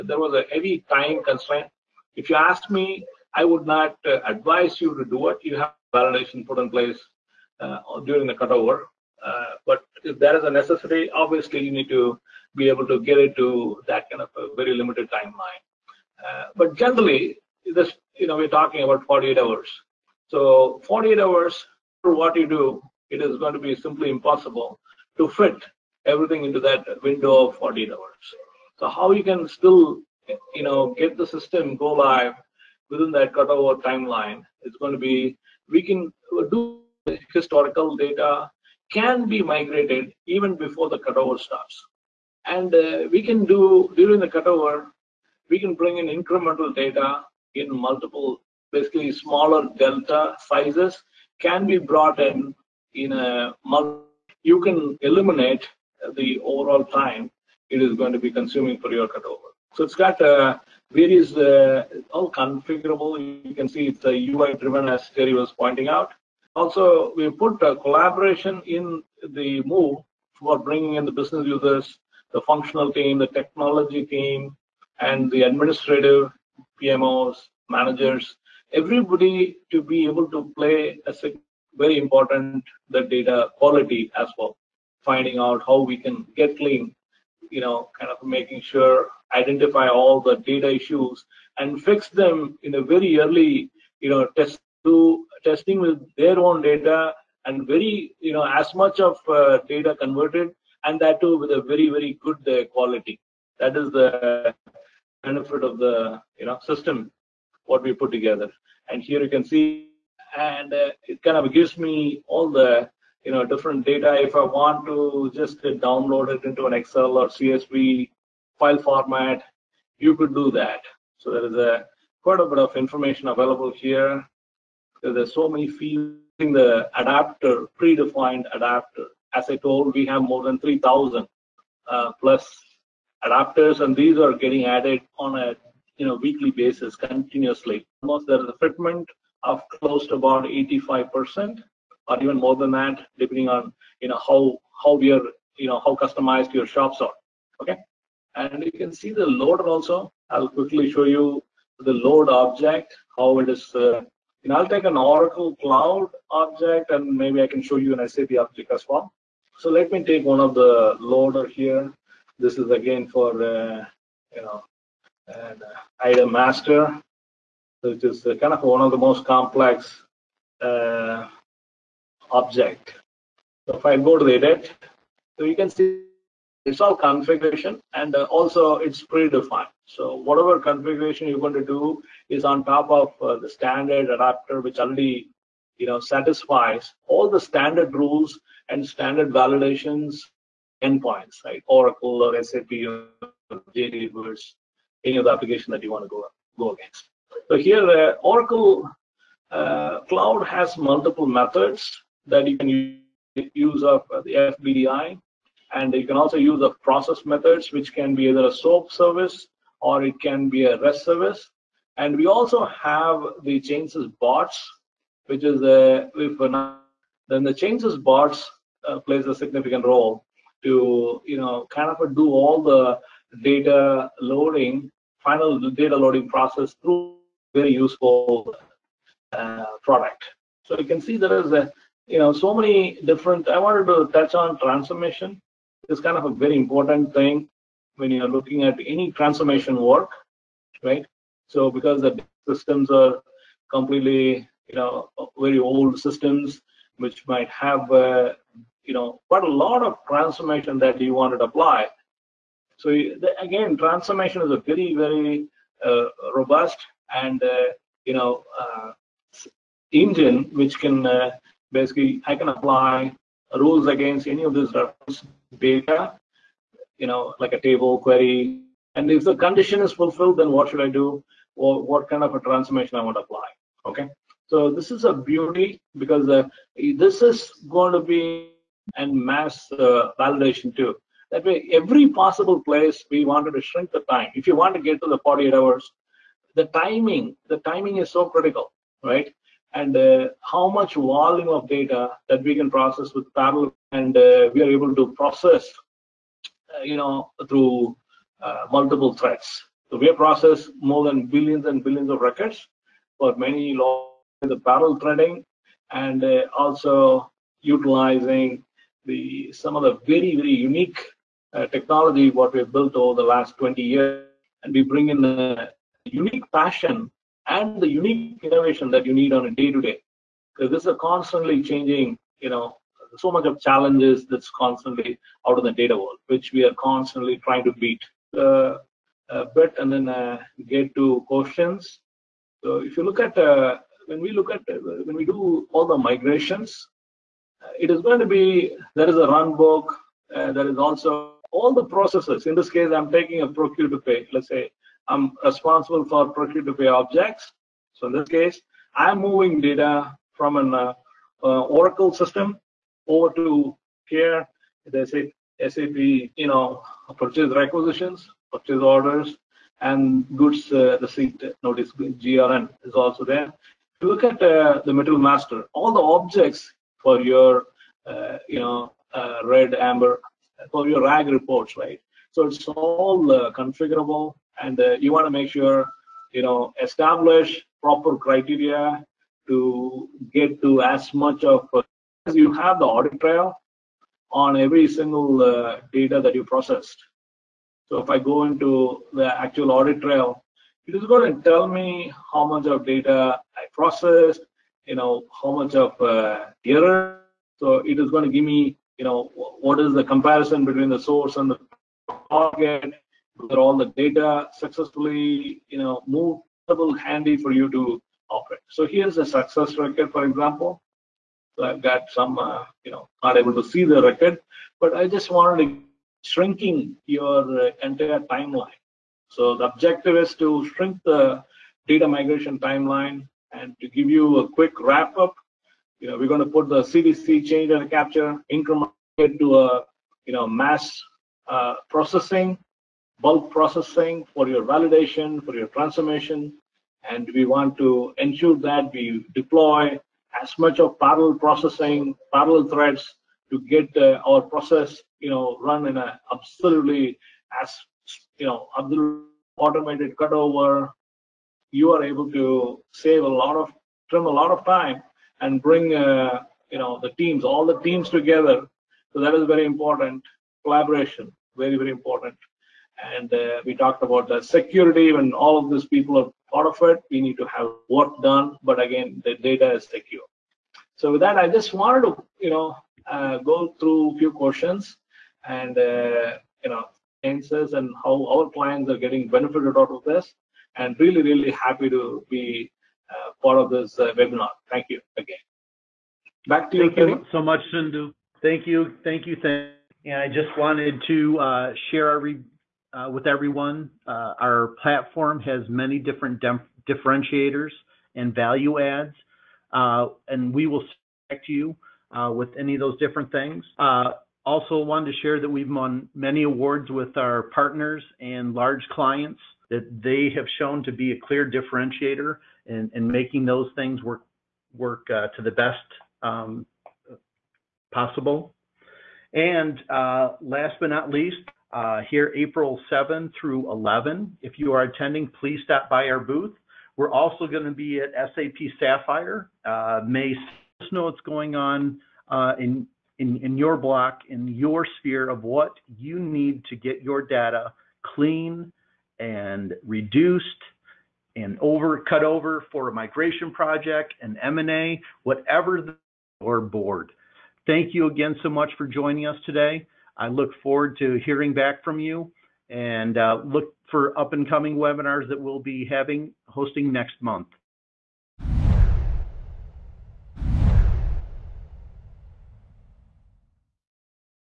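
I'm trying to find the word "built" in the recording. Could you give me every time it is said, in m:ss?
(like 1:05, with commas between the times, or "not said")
5:12.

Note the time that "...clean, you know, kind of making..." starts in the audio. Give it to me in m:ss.
1:26.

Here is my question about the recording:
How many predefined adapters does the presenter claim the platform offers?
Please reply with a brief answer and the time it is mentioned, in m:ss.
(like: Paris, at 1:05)
more than 3,000, at 2:10.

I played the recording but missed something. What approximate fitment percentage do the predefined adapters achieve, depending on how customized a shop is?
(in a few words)
85%.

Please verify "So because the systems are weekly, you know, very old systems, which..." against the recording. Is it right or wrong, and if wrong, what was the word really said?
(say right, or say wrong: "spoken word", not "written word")
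wrong: "completely", not "weekly".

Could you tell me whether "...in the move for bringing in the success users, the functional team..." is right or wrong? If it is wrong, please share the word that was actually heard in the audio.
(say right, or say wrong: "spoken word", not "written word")
wrong: "business", not "success".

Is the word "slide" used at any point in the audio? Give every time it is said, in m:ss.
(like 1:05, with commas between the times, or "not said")
not said.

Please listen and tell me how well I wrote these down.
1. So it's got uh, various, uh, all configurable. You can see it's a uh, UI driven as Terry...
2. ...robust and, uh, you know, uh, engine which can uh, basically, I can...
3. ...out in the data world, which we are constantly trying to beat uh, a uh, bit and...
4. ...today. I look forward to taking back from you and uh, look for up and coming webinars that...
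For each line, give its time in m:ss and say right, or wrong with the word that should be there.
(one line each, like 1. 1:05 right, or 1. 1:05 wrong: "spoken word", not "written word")
1. 0:59 right
2. 4:16 right
3. 5:25 right
4. 9:09 wrong: "hearing", not "taking".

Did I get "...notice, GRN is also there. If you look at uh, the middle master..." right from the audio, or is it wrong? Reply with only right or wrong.
right.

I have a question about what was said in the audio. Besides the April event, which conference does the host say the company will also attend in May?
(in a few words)
SAP Sapphire.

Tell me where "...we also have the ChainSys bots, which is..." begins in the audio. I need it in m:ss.
3:32.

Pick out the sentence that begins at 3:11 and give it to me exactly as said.
Oracle or SAP or JD Edwards, any of the application that you want to go go against.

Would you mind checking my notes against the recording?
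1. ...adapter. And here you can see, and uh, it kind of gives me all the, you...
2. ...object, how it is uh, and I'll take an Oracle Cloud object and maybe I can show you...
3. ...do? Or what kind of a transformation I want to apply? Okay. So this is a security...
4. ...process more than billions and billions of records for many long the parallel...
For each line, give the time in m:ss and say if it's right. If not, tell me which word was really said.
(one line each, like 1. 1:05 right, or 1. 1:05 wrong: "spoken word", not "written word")
1. 1:48 wrong: "together", not "adapter"
2. 2:32 right
3. 4:30 wrong: "beauty", not "security"
4. 5:00 right.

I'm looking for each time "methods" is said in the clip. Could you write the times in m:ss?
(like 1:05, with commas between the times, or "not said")
3:21, 3:27.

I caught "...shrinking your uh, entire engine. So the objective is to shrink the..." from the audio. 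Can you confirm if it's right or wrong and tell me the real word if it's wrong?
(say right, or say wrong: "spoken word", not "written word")
wrong: "timeline", not "engine".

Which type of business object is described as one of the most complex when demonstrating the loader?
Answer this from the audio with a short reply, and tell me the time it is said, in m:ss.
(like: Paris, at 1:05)
item master, at 2:45.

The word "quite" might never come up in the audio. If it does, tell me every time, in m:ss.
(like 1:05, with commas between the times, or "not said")
2:02, 4:09.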